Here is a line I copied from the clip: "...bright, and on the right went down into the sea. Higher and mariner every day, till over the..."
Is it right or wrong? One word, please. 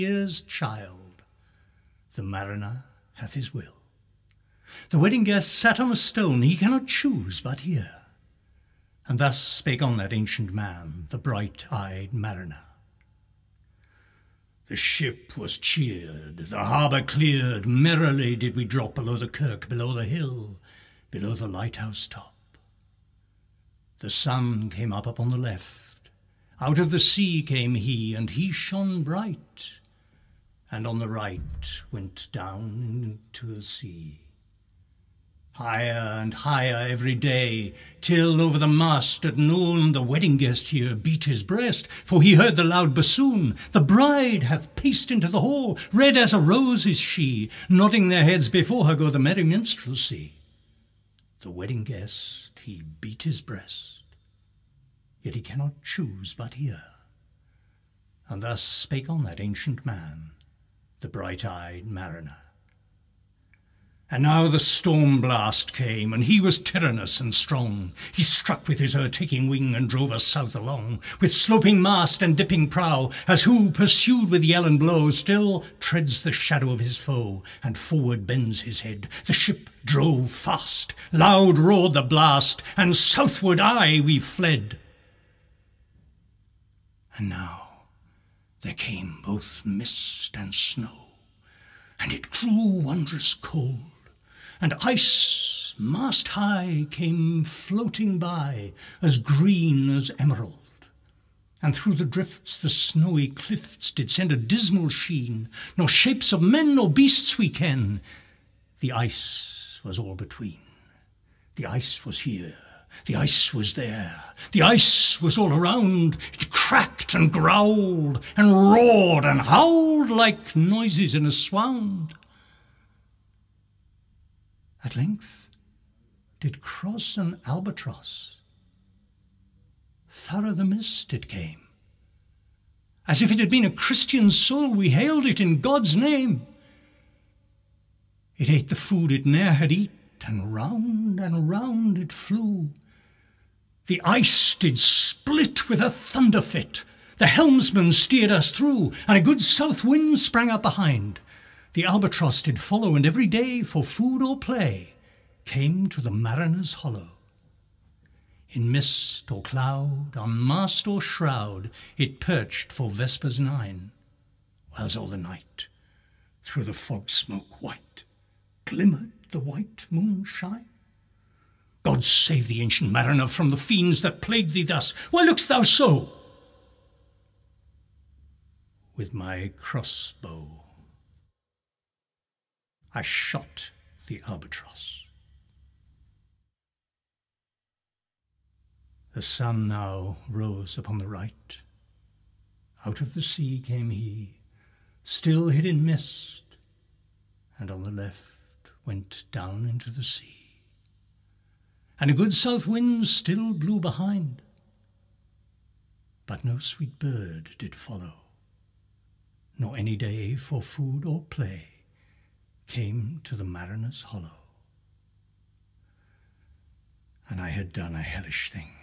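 wrong.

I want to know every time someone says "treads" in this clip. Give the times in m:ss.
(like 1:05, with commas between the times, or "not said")
1:15.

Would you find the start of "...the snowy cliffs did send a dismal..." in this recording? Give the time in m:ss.
1:42.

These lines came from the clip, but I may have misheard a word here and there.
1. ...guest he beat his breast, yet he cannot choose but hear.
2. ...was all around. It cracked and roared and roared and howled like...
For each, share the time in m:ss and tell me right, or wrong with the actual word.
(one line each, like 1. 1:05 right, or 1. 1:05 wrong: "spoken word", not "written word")
1. 0:51 right
2. 1:55 wrong: "growled", not "roared".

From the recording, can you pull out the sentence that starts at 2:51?
God save the ancient mariner from the fiends that plague thee thus.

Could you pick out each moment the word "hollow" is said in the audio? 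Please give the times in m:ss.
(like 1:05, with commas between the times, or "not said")
2:36, 3:34.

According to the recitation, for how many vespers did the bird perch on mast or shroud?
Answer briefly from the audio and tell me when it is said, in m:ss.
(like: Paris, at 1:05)
9, at 2:43.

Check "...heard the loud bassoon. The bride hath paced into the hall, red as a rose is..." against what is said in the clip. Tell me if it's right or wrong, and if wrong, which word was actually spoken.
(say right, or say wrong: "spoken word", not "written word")
right.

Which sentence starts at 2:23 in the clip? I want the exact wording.
The ice did split with a thunder fit.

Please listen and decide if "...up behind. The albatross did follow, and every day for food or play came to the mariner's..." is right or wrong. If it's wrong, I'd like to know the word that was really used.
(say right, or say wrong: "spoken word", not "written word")
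right.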